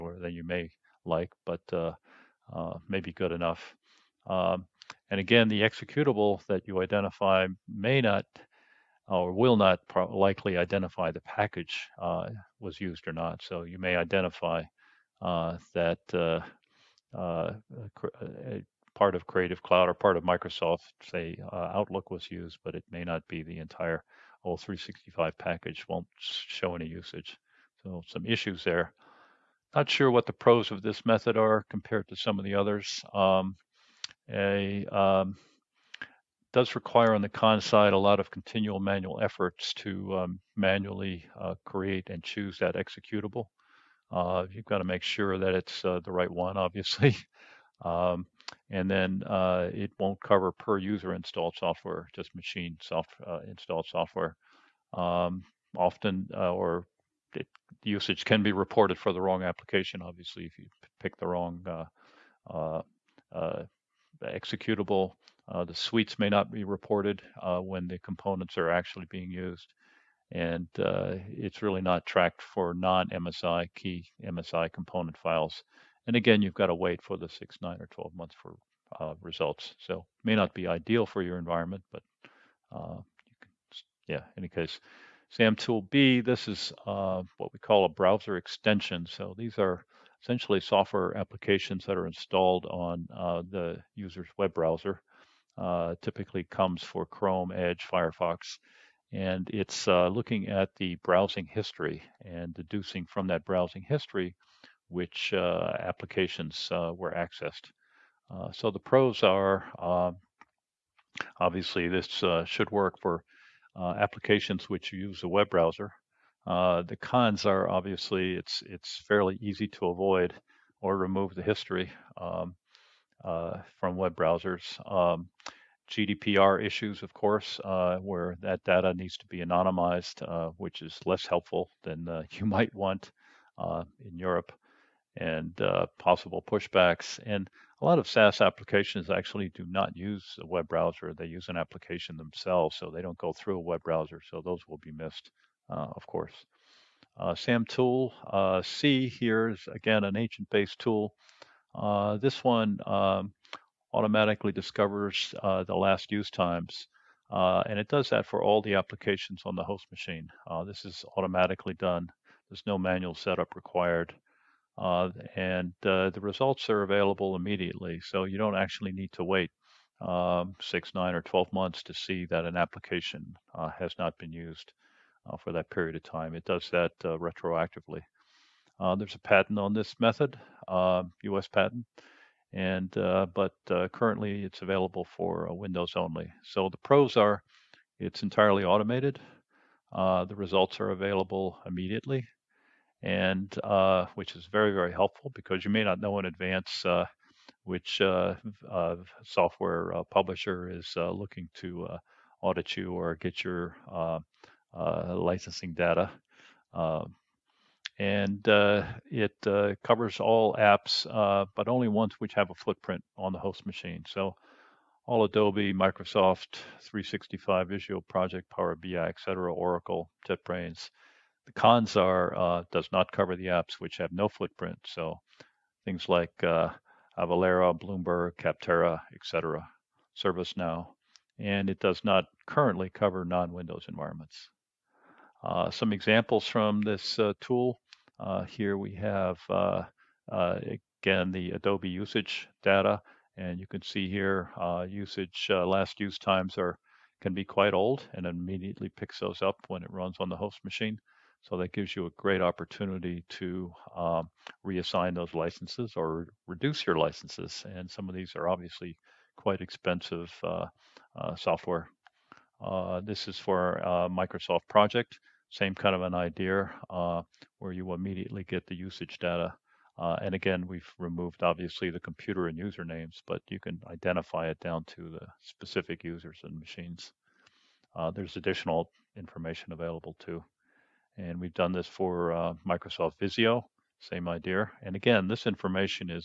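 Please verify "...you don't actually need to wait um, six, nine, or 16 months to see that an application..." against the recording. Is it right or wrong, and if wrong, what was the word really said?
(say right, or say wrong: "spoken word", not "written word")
wrong: "12", not "16".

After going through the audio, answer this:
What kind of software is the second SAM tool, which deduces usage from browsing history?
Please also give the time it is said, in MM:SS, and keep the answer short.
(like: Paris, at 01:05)
Browser extension, at 01:27.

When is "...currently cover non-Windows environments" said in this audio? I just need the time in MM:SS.
03:52.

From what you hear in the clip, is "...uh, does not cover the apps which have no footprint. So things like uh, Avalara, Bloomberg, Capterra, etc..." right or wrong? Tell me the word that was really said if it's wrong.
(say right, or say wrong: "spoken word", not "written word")
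right.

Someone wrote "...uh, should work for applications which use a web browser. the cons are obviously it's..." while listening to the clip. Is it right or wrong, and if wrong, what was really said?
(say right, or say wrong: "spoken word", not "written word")
right.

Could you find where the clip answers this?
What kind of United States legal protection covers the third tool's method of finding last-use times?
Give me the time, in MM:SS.
03:01.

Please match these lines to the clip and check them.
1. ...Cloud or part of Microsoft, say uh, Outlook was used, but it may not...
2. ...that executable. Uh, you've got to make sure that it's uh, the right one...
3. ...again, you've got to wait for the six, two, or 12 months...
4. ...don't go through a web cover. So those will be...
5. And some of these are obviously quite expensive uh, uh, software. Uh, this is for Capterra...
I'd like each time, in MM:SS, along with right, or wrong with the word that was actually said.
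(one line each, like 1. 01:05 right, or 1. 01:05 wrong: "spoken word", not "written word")
1. 00:19 right
2. 00:42 right
3. 01:16 wrong: "nine", not "two"
4. 02:23 wrong: "browser", not "cover"
5. 04:17 wrong: "Microsoft", not "Capterra".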